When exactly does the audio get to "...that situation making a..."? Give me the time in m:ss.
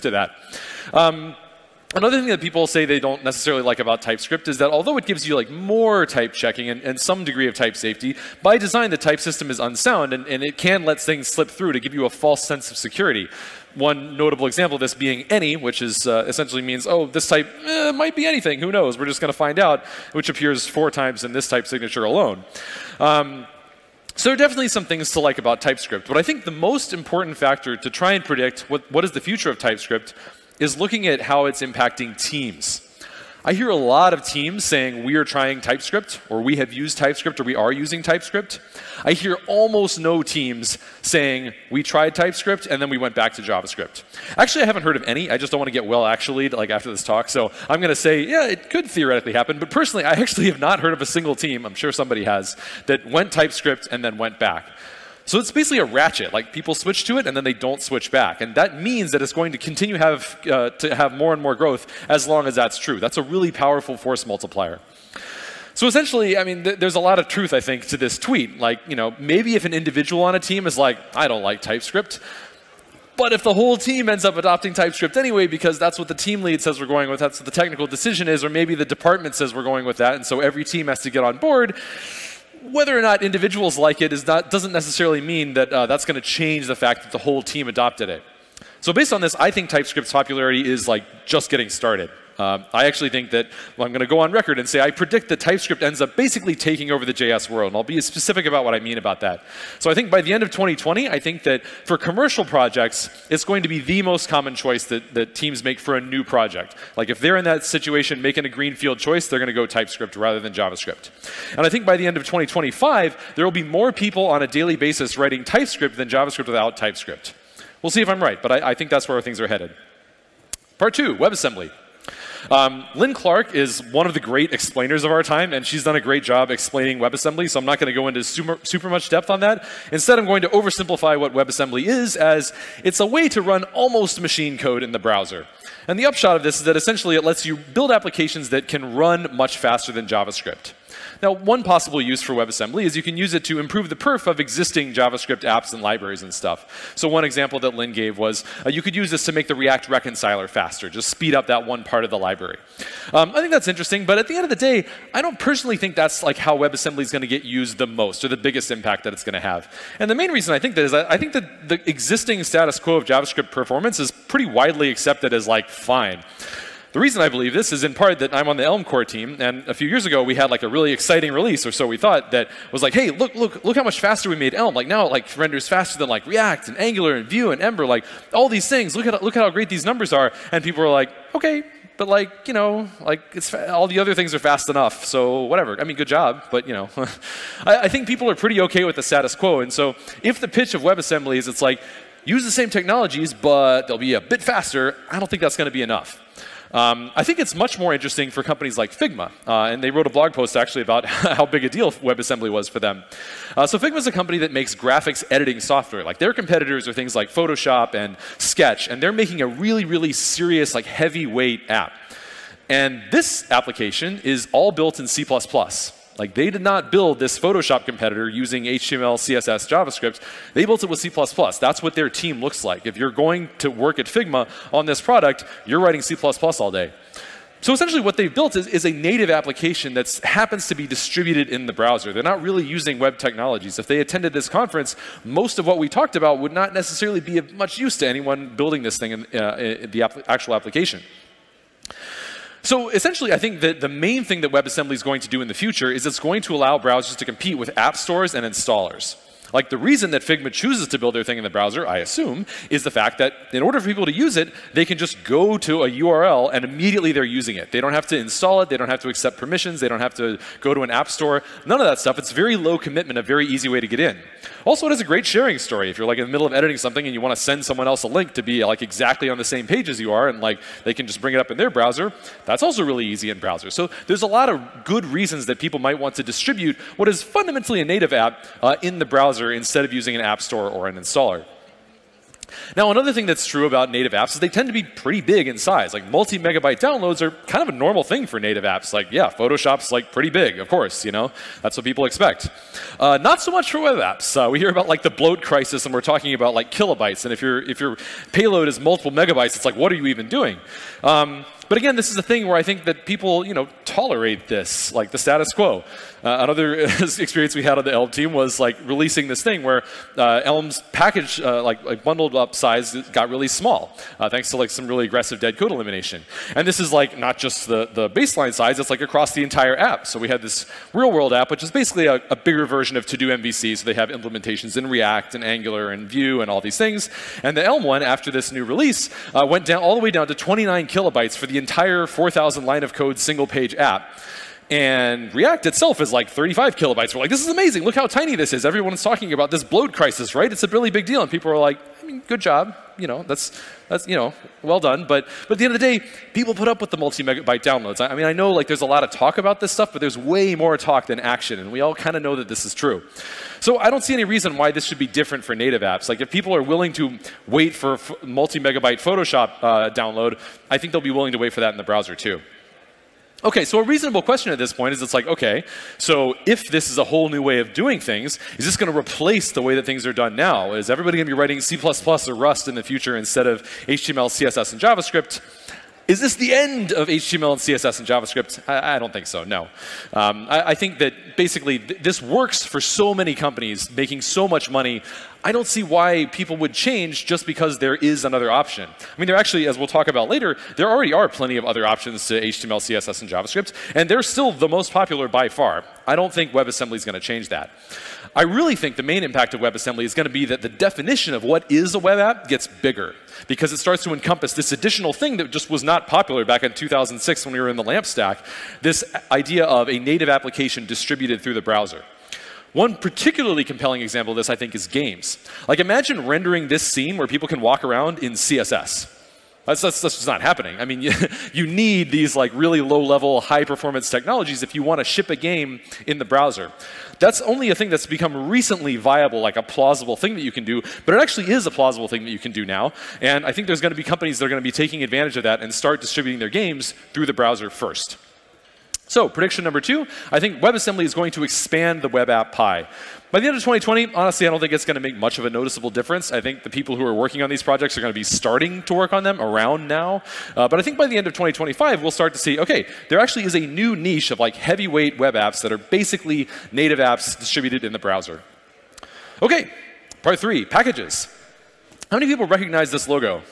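1:47.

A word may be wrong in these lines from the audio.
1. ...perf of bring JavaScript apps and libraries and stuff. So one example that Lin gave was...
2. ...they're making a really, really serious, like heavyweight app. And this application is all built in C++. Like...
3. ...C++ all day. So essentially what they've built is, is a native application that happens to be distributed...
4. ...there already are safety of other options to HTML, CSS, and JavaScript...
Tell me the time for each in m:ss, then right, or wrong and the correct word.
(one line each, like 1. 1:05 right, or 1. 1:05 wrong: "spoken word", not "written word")
1. 2:23 wrong: "existing", not "bring"
2. 3:29 right
3. 3:46 right
4. 6:30 wrong: "plenty", not "safety".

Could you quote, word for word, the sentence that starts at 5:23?
So they have implementations in React and Angular and Vue and all these things.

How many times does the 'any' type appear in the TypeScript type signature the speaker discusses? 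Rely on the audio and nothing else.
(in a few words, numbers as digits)
4.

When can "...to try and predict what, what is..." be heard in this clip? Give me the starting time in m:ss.
0:27.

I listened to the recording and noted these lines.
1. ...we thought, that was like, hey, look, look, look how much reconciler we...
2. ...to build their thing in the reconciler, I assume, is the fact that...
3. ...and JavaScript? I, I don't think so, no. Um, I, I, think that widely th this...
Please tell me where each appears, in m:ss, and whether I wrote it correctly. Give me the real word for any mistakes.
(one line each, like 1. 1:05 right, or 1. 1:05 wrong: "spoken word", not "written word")
1. 2:51 wrong: "faster", not "reconciler"
2. 4:10 wrong: "browser", not "reconciler"
3. 6:17 wrong: "basically", not "widely".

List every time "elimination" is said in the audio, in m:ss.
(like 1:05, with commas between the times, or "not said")
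5:15.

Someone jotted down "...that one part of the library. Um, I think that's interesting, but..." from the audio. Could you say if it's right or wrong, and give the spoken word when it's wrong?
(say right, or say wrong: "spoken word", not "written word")
right.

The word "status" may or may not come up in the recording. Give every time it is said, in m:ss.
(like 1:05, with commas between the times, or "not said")
2:42, 3:09, 5:05.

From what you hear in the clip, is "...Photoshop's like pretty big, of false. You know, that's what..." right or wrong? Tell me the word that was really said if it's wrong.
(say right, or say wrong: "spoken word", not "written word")
wrong: "course", not "false".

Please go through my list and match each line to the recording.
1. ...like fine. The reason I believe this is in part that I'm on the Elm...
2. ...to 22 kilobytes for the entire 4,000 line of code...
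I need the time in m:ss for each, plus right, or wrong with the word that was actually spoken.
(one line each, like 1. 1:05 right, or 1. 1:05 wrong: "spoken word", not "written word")
1. 2:45 right
2. 5:30 wrong: "29", not "22".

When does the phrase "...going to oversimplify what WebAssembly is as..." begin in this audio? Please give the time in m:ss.
2:10.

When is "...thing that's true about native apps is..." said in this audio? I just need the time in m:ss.
4:43.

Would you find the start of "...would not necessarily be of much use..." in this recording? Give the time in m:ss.
3:56.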